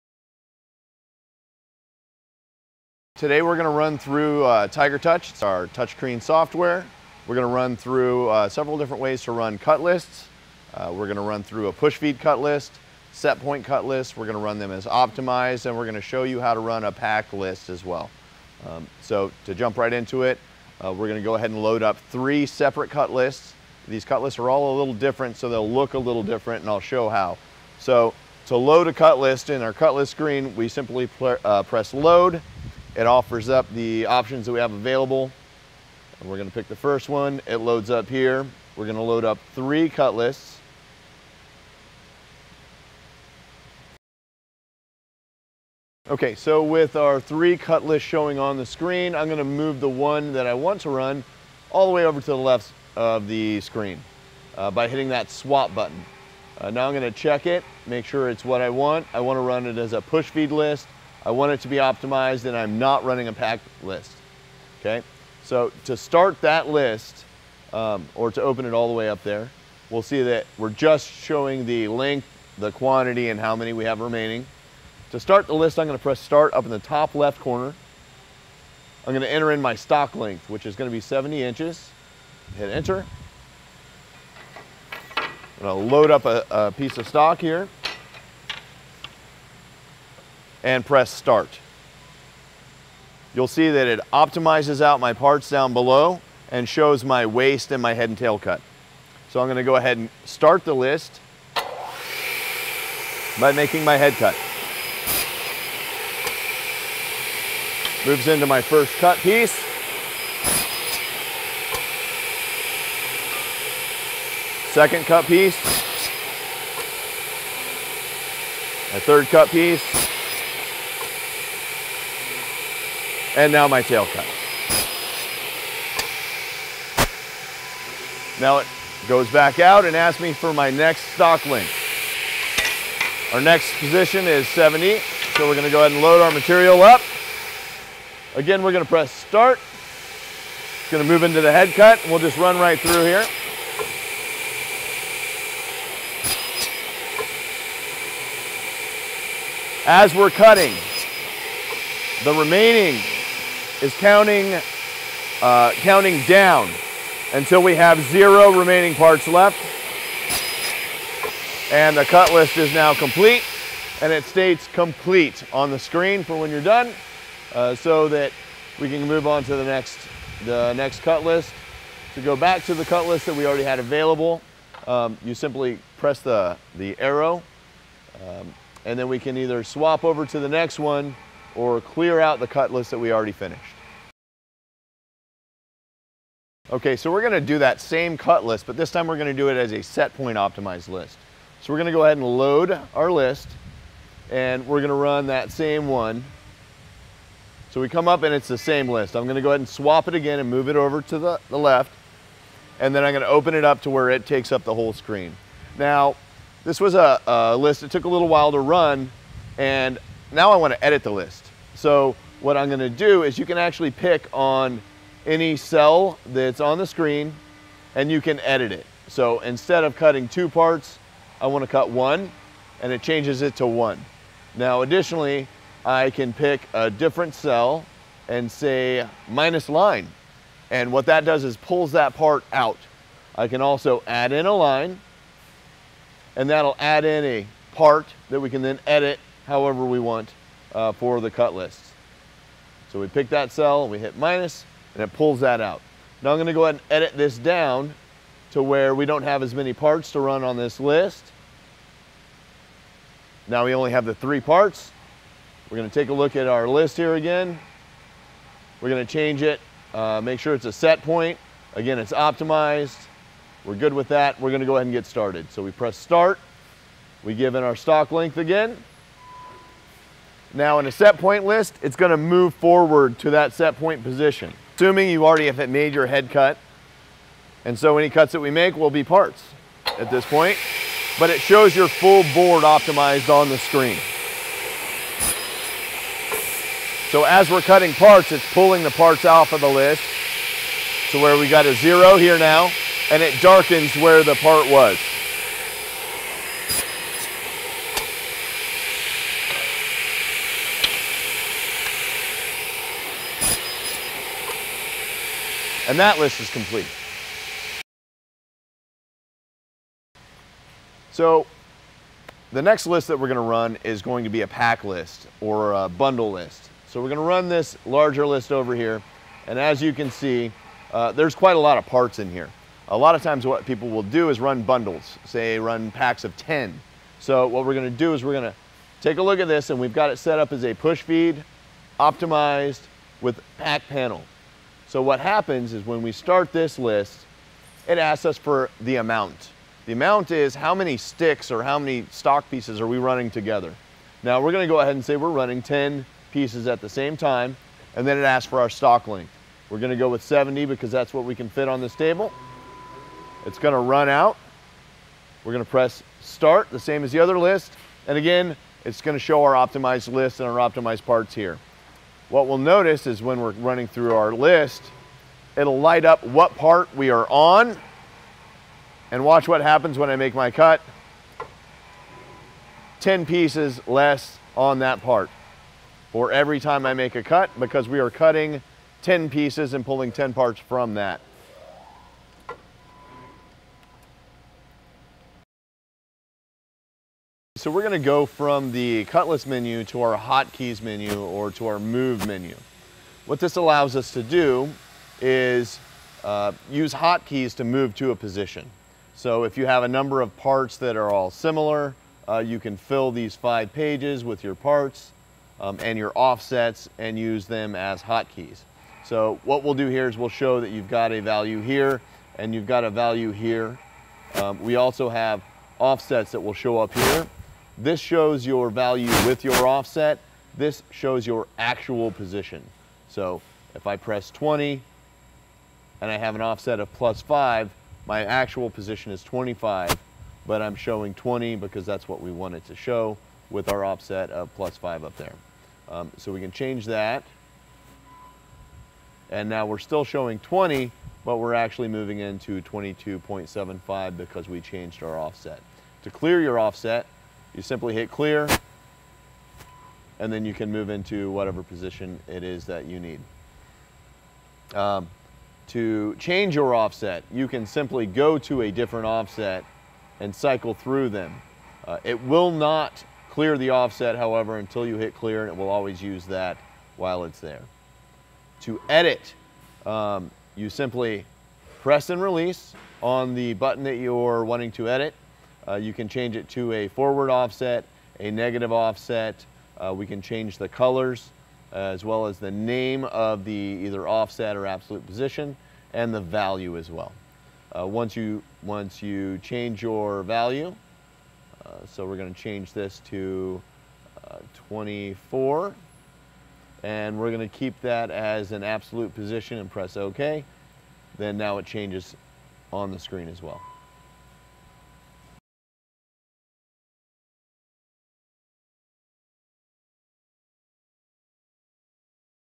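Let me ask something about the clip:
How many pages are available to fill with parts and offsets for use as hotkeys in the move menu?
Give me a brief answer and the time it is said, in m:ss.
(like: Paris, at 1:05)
5, at 6:43.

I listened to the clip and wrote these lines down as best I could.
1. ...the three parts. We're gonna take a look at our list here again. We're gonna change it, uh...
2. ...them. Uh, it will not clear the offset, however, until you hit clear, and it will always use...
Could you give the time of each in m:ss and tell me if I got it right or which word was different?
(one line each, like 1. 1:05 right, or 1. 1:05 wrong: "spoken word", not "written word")
1. 4:14 right
2. 7:41 right.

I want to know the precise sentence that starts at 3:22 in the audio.
And then I'm gonna open it up to where it takes up the whole screen.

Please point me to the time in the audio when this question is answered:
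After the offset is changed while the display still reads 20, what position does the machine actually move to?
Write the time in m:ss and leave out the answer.
7:22.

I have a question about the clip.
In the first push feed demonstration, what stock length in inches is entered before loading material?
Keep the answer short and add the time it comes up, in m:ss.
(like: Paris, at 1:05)
70 inches, at 1:20.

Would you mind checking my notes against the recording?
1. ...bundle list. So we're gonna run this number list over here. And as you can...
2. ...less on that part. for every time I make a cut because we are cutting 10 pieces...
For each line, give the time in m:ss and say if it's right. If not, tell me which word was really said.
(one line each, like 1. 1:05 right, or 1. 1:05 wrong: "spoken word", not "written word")
1. 5:15 wrong: "larger", not "number"
2. 6:13 right.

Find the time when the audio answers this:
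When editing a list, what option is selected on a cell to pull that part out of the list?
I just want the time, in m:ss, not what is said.
3:49.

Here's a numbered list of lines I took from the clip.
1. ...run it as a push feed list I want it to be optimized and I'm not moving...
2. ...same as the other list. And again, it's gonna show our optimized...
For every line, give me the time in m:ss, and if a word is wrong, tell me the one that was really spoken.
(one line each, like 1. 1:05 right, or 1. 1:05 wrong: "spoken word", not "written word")
1. 0:59 wrong: "running", not "moving"
2. 5:56 right.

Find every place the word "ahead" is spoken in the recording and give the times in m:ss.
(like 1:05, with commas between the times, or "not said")
0:21, 1:39, 2:15, 3:12, 3:19, 4:06, 4:24, 5:44.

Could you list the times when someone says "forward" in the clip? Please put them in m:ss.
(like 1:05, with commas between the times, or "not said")
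4:32, 7:56.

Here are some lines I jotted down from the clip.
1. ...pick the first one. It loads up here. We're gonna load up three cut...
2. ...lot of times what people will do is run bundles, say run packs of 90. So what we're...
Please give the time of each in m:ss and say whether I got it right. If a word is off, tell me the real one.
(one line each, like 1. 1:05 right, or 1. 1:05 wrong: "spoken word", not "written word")
1. 0:36 right
2. 5:22 wrong: "10", not "90".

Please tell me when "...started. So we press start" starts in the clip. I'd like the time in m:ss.
4:25.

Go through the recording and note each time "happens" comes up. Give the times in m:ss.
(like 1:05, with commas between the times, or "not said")
5:35, 6:09.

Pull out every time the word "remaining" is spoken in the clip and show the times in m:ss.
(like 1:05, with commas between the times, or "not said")
1:14, 2:32, 2:38.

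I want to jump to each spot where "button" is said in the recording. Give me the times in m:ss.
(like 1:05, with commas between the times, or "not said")
0:55, 7:53.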